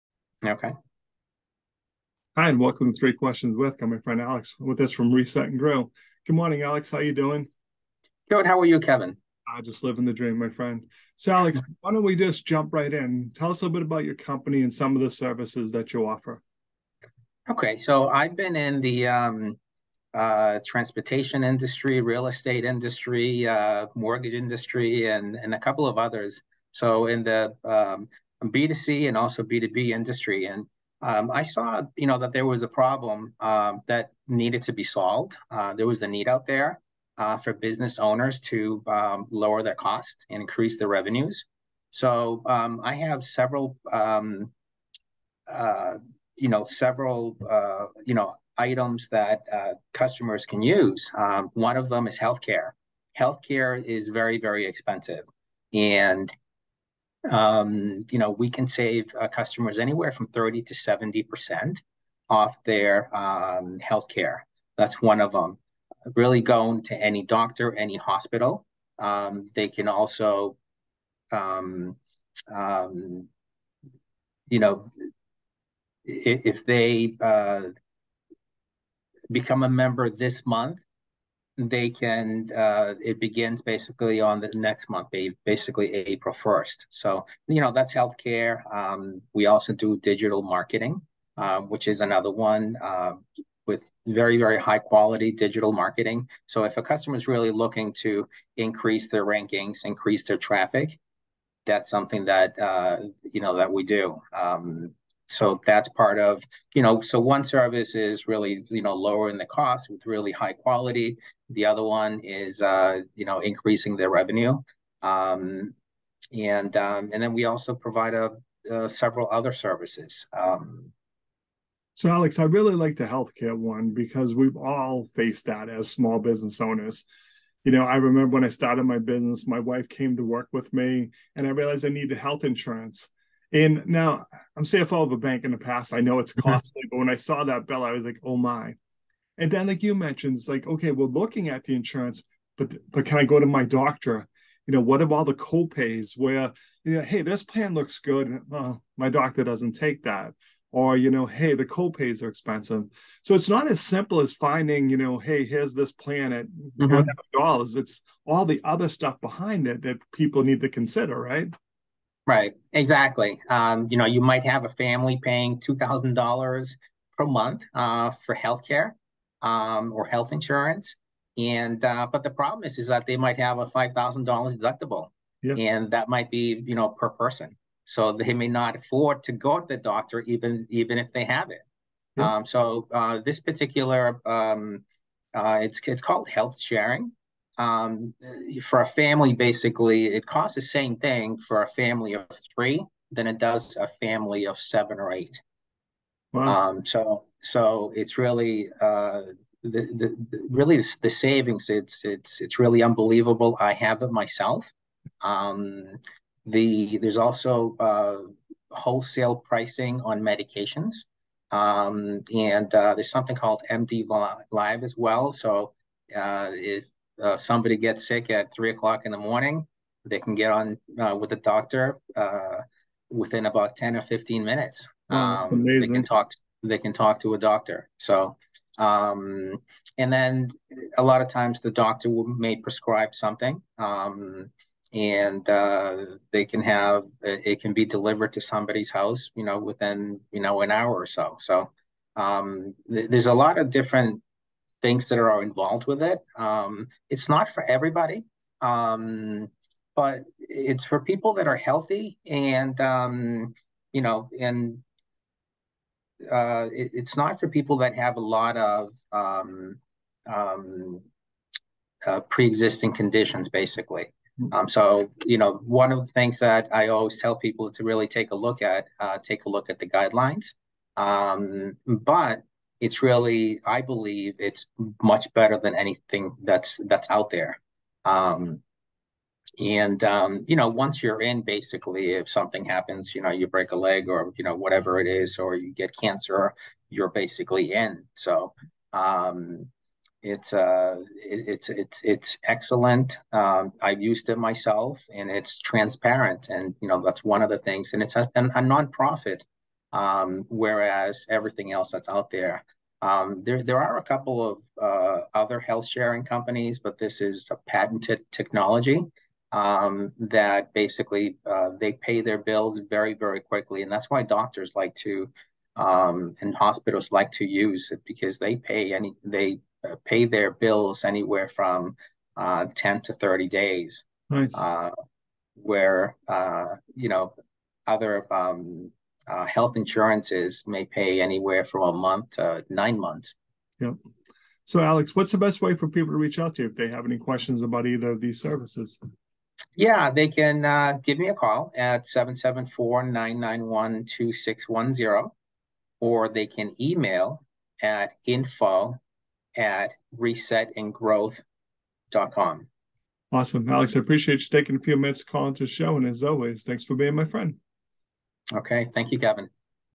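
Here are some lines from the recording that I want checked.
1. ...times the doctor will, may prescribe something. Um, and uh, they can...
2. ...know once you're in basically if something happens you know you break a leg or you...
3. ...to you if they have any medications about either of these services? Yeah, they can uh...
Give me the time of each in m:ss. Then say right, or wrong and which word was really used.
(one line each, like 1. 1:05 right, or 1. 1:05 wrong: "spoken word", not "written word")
1. 3:51 right
2. 4:40 right
3. 5:36 wrong: "questions", not "medications".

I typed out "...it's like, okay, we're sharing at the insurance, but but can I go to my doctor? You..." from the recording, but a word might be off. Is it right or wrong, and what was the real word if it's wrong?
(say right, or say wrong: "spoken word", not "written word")
wrong: "looking", not "sharing".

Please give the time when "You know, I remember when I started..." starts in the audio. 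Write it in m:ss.
2:07.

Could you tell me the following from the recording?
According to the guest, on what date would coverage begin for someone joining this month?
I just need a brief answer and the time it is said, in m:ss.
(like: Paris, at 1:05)
April 1st, at 1:25.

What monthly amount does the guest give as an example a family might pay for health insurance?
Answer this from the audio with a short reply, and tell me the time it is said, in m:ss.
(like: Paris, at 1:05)
$2,000, at 2:45.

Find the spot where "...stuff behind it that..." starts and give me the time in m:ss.
2:38.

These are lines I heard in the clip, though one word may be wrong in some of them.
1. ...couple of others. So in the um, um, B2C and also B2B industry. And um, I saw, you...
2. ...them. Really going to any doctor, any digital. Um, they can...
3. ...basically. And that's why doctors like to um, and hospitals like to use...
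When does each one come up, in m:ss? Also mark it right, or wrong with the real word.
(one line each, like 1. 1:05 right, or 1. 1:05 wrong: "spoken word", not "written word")
1. 0:25 right
2. 1:05 wrong: "hospital", not "digital"
3. 5:13 wrong: "quickly", not "basically".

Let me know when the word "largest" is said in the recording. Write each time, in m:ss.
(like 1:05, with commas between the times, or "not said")
not said.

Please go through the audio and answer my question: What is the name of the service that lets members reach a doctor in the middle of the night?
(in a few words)
MD Live.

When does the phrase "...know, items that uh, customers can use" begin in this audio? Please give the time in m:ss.
0:48.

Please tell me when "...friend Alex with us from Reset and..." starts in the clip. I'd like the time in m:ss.
0:03.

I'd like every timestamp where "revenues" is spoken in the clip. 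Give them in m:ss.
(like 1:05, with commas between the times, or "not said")
0:40, 1:54.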